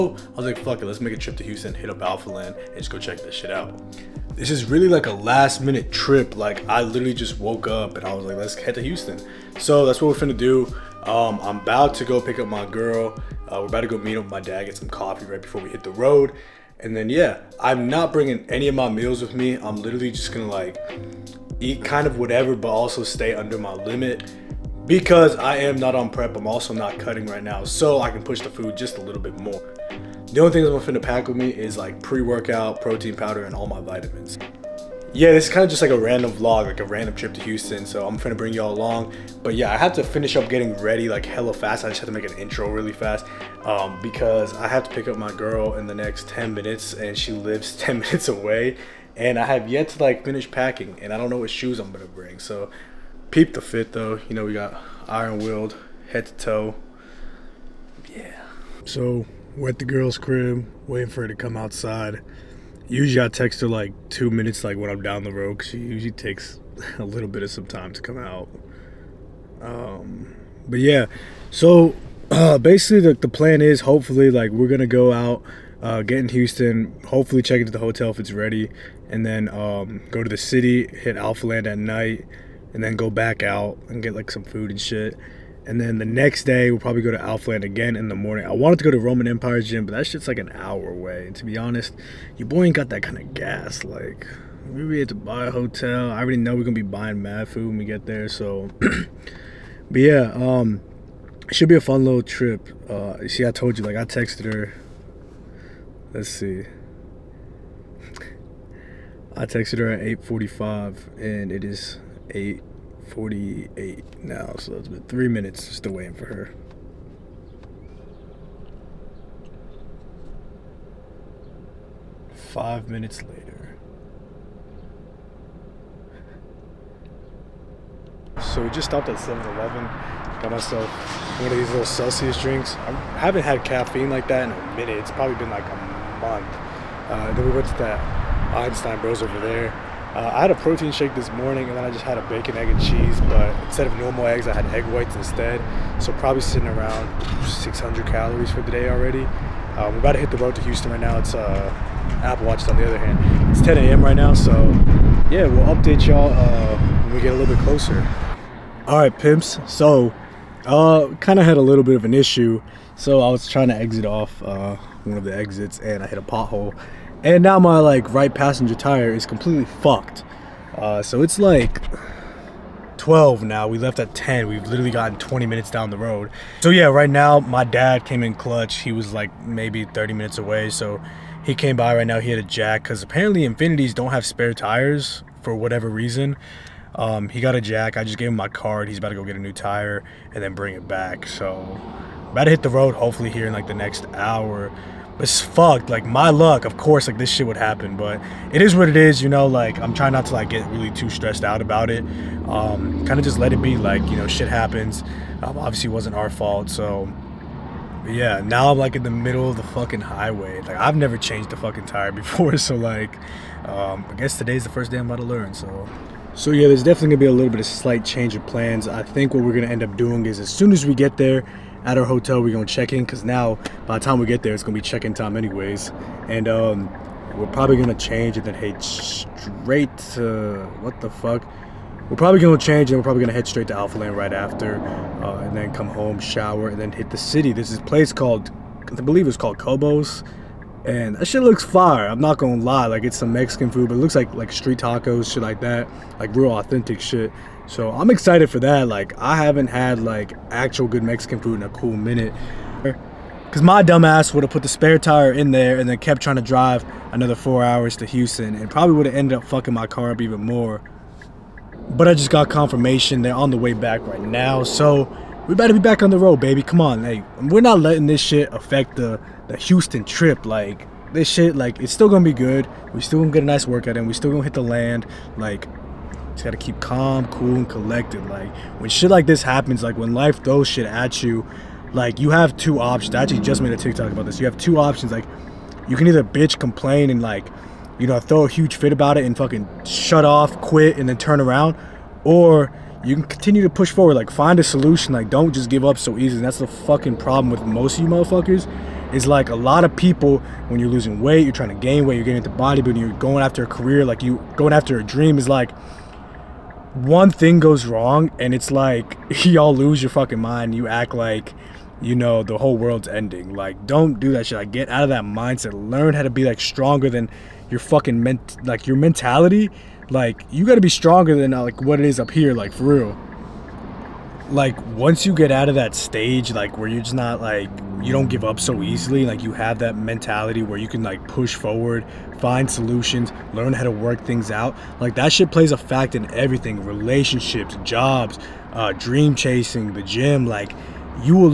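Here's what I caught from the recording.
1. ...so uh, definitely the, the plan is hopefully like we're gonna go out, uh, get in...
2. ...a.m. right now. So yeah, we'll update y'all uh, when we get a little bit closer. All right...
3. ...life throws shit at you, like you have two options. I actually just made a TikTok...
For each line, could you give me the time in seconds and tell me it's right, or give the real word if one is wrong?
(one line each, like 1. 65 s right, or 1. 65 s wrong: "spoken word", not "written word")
1. 71 s wrong: "basically", not "definitely"
2. 153 s right
3. 280 s right.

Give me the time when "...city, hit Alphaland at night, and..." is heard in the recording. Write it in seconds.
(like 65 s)
80 s.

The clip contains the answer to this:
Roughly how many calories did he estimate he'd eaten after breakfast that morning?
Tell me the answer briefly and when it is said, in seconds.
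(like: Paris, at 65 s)
600, at 147 s.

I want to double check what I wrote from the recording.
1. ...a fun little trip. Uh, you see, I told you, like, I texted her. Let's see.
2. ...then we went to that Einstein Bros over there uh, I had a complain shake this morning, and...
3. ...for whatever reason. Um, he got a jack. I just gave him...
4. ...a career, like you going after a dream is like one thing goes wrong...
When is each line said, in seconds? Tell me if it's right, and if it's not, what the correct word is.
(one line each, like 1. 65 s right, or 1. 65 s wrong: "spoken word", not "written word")
1. 101 s right
2. 137 s wrong: "protein", not "complain"
3. 185 s right
4. 303 s right.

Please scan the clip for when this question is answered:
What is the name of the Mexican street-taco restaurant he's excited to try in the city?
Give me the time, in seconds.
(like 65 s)
239 s.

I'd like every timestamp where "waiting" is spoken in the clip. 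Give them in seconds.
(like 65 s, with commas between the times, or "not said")
60 s, 115 s.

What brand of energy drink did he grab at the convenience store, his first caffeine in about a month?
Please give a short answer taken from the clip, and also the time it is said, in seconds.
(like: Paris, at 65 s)
Celsius, at 131 s.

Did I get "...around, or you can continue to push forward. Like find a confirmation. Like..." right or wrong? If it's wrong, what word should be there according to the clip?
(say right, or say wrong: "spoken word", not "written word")
wrong: "solution", not "confirmation".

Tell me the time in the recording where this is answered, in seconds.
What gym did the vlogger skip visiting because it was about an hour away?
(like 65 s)
88 s.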